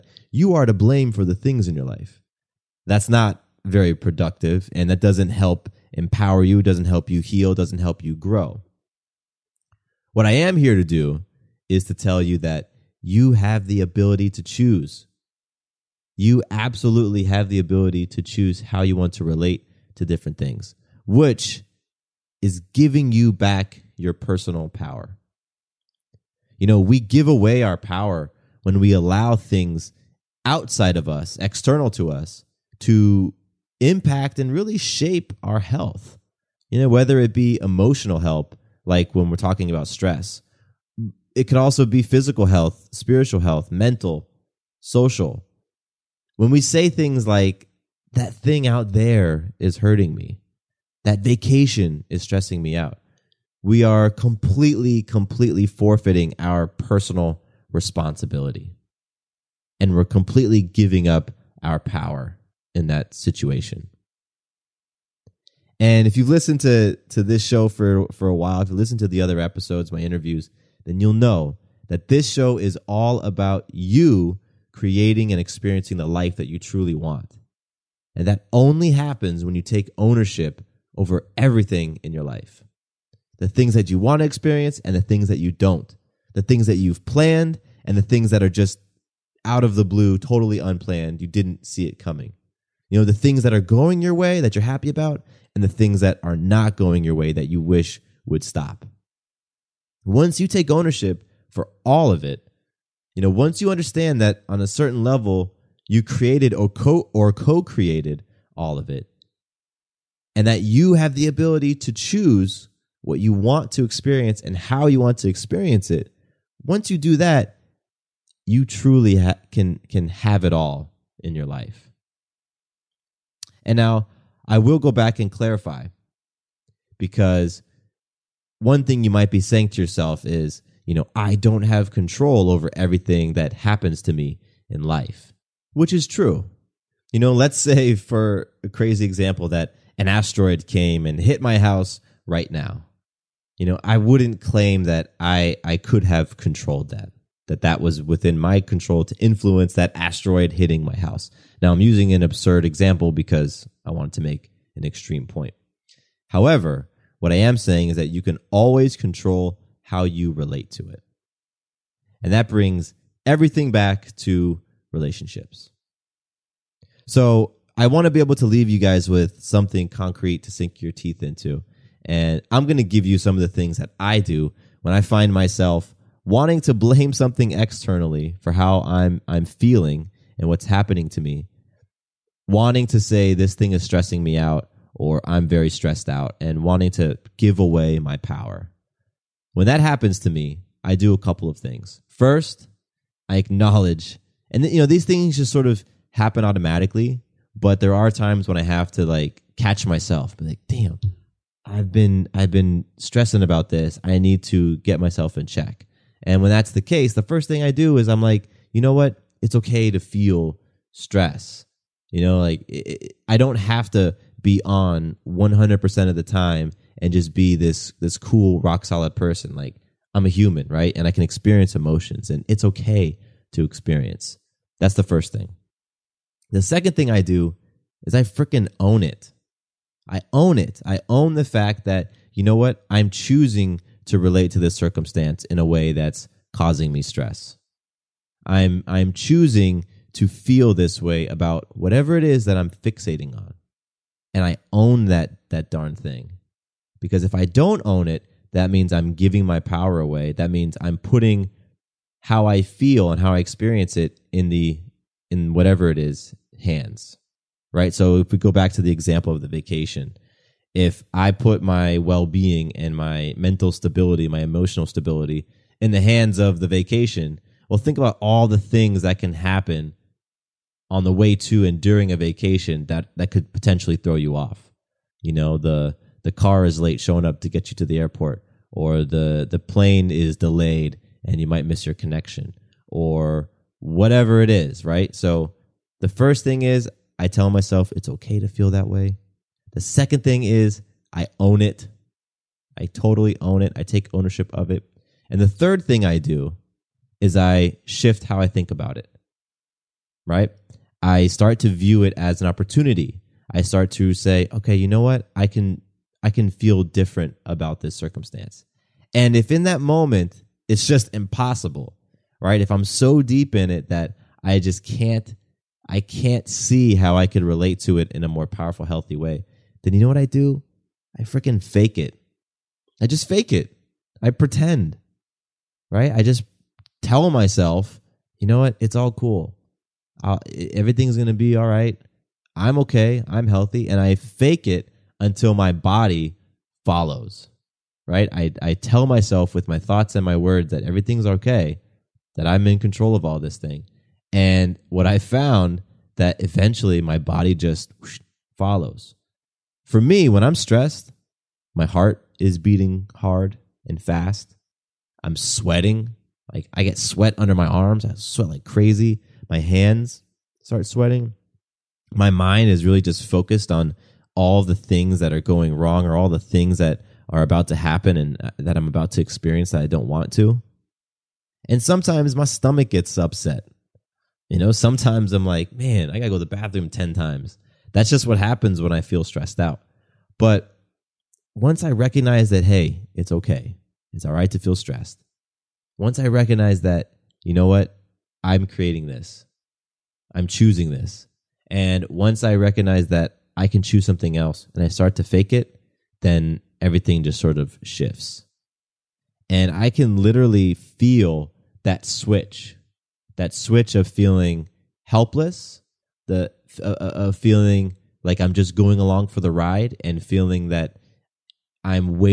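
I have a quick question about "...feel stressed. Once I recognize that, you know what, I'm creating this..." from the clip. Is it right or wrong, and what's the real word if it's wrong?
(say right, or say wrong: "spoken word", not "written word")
right.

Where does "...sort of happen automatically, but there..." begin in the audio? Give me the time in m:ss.
3:15.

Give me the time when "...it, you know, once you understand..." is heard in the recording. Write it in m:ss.
1:42.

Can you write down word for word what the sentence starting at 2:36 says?
However, what I am saying is that you can always control how you relate to it.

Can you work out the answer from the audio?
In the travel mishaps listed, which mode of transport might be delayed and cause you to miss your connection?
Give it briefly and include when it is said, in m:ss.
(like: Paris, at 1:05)
plane, at 4:39.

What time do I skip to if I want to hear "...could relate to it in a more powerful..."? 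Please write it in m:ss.
5:17.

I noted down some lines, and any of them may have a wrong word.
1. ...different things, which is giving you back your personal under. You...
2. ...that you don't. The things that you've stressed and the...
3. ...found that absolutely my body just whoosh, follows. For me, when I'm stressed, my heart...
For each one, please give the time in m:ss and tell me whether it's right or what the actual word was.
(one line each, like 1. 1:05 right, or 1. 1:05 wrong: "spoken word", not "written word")
1. 0:20 wrong: "power", not "under"
2. 1:25 wrong: "planned", not "stressed"
3. 5:45 wrong: "eventually", not "absolutely".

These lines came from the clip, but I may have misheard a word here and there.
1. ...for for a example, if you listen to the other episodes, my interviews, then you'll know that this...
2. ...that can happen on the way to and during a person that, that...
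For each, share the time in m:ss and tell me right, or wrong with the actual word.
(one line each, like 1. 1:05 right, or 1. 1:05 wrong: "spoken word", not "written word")
1. 1:07 wrong: "while", not "example"
2. 4:29 wrong: "vacation", not "person".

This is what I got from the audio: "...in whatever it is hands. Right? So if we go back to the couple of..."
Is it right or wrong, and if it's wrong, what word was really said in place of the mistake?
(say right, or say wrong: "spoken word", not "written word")
wrong: "example", not "couple".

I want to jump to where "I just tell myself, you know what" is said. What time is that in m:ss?
5:26.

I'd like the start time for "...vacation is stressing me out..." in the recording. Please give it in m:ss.
0:51.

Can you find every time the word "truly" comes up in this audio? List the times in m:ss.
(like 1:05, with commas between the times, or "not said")
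1:16, 1:58.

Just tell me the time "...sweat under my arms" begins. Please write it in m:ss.
5:56.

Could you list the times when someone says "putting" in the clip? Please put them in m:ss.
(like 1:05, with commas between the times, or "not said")
4:10.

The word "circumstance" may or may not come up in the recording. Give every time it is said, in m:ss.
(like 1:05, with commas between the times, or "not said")
3:54, 5:07.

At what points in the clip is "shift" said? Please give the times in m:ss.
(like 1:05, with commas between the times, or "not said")
4:57, 6:37.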